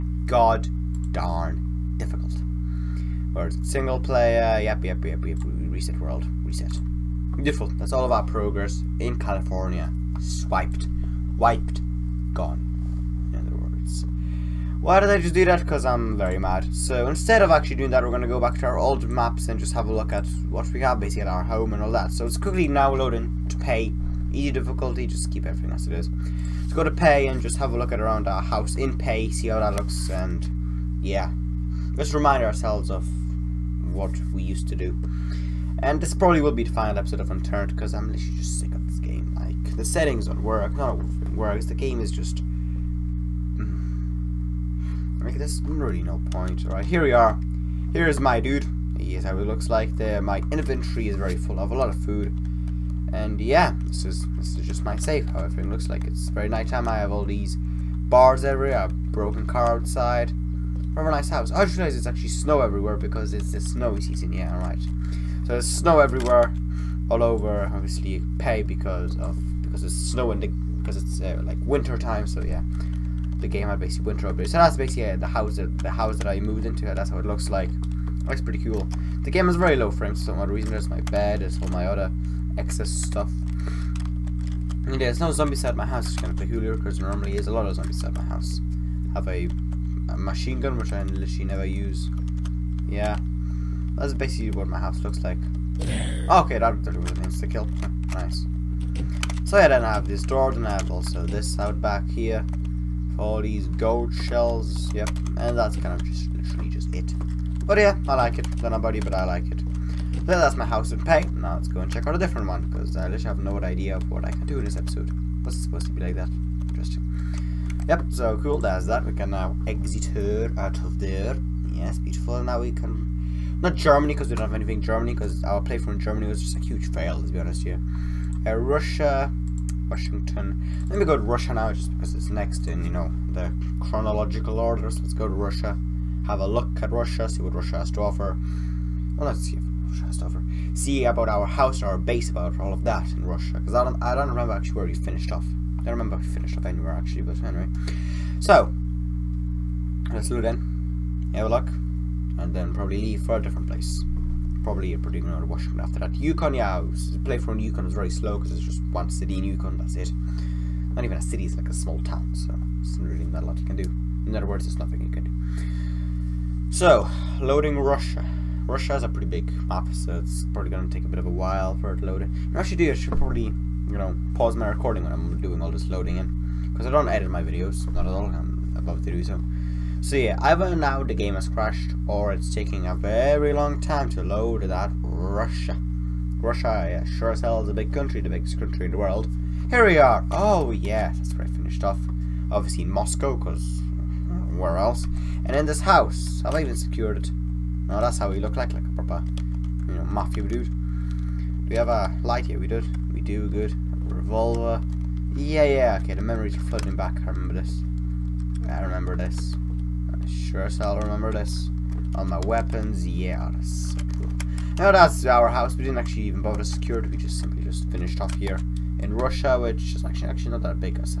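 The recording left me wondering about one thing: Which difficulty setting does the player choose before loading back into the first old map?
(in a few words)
Easy.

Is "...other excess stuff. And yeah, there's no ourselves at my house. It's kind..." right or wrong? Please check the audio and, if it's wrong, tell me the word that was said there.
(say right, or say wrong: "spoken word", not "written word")
wrong: "zombies", not "ourselves".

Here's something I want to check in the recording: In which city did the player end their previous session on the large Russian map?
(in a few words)
Moscow.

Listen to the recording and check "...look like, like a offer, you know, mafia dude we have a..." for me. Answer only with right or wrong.
wrong.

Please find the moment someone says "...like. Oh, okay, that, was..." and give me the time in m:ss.
1:35.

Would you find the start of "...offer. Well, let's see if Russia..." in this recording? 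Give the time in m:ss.
2:18.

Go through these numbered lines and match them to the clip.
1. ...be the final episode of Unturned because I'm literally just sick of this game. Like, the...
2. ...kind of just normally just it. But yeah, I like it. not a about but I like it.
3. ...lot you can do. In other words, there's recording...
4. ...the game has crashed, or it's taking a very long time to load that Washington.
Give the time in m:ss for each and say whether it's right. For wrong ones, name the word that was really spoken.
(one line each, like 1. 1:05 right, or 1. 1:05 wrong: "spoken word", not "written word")
1. 0:36 right
2. 1:45 wrong: "literally", not "normally"
3. 2:43 wrong: "nothing", not "recording"
4. 3:01 wrong: "Russia", not "Washington".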